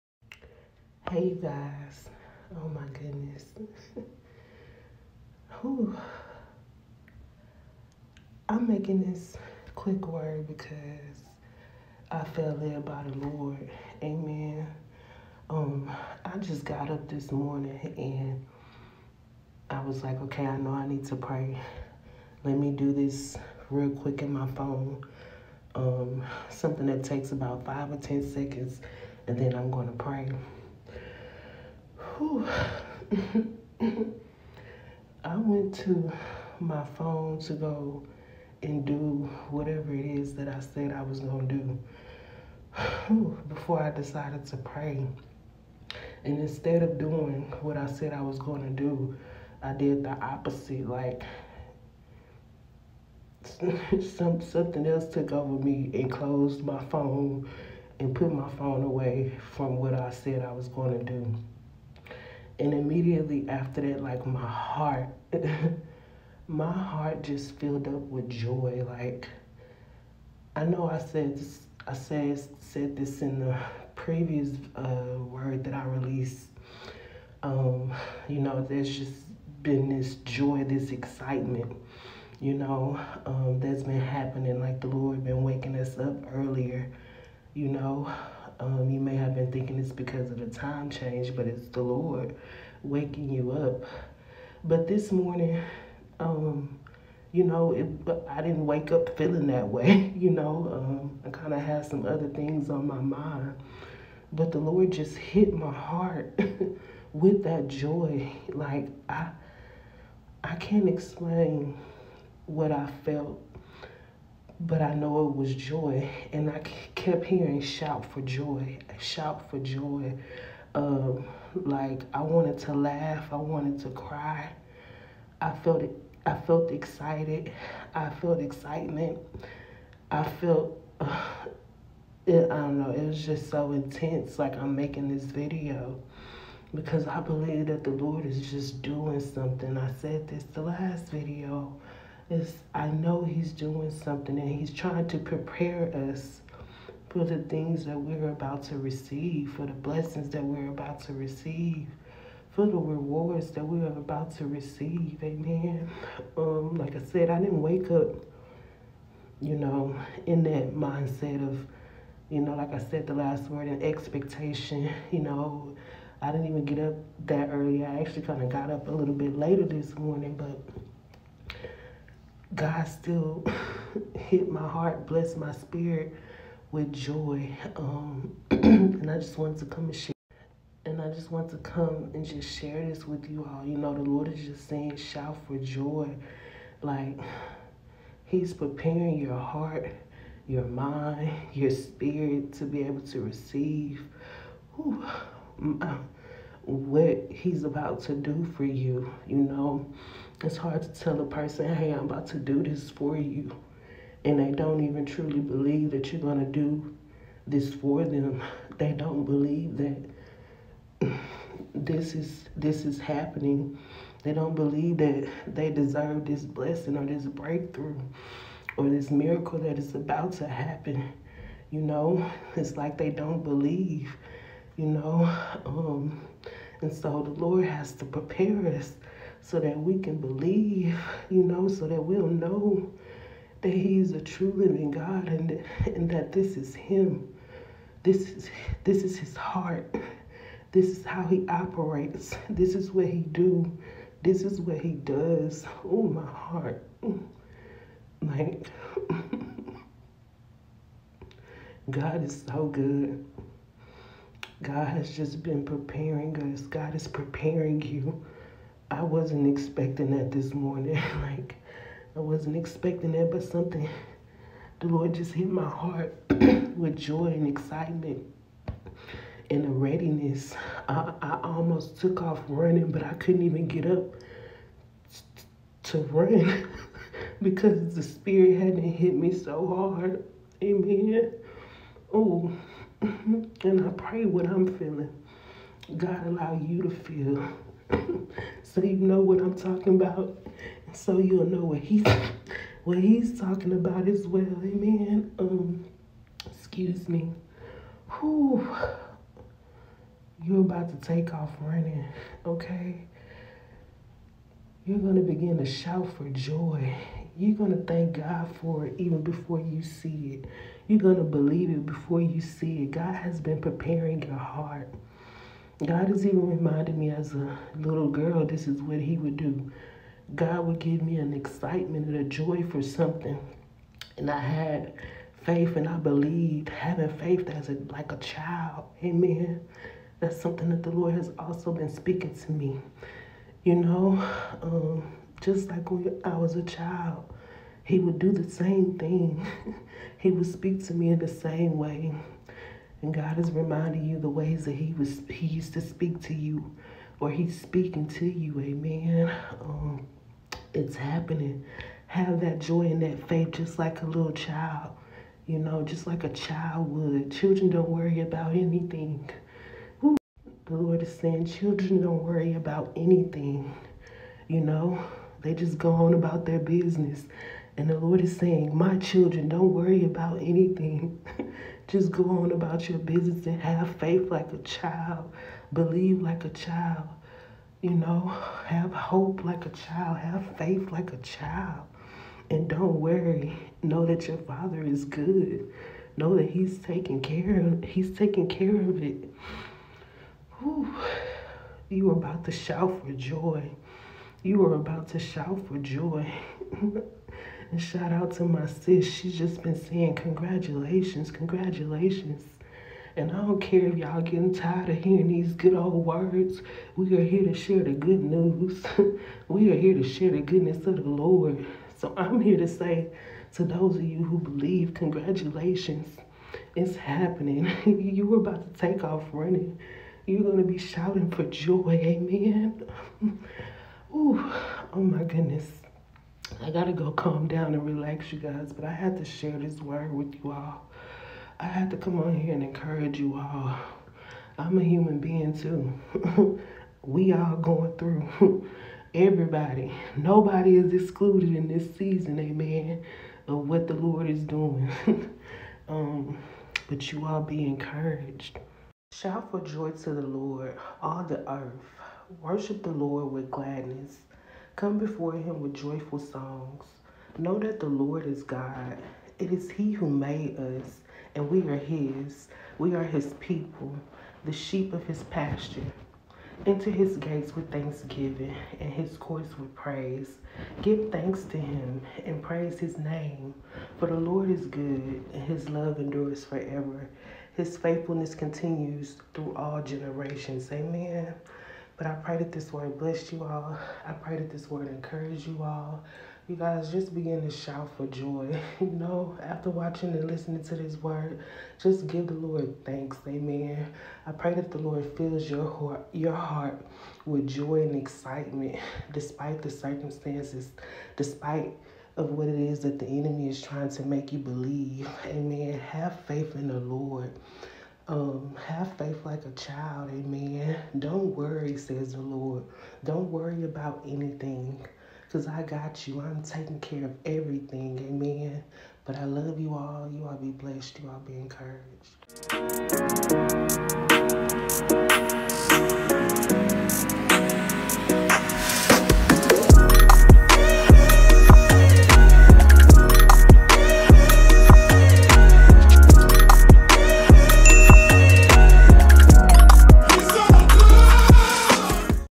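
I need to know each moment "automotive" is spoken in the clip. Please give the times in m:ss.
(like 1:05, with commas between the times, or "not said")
not said.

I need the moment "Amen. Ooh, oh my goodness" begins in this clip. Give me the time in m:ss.
7:02.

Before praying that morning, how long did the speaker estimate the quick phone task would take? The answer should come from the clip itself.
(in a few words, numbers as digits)
5 or 10 seconds.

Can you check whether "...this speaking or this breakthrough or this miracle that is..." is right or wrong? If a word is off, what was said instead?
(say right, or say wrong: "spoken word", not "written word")
wrong: "blessing", not "speaking".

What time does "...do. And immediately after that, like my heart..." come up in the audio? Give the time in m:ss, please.
1:01.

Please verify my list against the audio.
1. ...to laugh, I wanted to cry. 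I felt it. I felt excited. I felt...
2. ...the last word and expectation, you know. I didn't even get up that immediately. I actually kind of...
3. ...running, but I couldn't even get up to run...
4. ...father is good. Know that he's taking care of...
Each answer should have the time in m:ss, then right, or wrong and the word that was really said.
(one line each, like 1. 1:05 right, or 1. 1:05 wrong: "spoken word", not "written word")
1. 2:02 right
2. 2:43 wrong: "early", not "immediately"
3. 4:32 right
4. 6:24 right.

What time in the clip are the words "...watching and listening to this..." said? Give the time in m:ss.
8:09.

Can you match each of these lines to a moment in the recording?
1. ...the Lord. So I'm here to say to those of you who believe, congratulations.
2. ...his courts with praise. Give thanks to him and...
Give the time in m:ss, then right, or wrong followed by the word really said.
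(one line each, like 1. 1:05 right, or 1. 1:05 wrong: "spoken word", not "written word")
1. 6:50 right
2. 7:48 right.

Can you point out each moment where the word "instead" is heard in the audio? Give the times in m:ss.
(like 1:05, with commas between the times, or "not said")
0:46.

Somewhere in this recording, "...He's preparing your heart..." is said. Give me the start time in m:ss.
3:08.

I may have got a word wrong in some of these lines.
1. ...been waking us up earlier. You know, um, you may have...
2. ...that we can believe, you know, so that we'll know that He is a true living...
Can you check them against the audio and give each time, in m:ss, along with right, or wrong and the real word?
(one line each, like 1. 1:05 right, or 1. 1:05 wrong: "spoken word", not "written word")
1. 1:25 right
2. 3:49 right.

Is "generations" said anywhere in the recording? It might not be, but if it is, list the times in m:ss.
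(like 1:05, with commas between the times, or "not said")
7:59.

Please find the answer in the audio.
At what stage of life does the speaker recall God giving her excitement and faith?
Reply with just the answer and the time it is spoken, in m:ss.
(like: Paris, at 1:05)
as a little girl, at 5:17.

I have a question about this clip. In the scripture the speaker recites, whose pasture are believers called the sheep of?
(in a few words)
his pasture.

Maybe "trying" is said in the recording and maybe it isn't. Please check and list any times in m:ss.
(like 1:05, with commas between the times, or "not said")
2:24, 8:23.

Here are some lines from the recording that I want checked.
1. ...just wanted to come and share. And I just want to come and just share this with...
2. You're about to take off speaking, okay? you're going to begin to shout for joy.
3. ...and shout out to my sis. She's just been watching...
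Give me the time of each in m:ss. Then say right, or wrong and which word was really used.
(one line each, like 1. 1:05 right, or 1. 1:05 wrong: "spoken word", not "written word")
1. 2:59 right
2. 5:00 wrong: "running", not "speaking"
3. 6:36 wrong: "saying", not "watching".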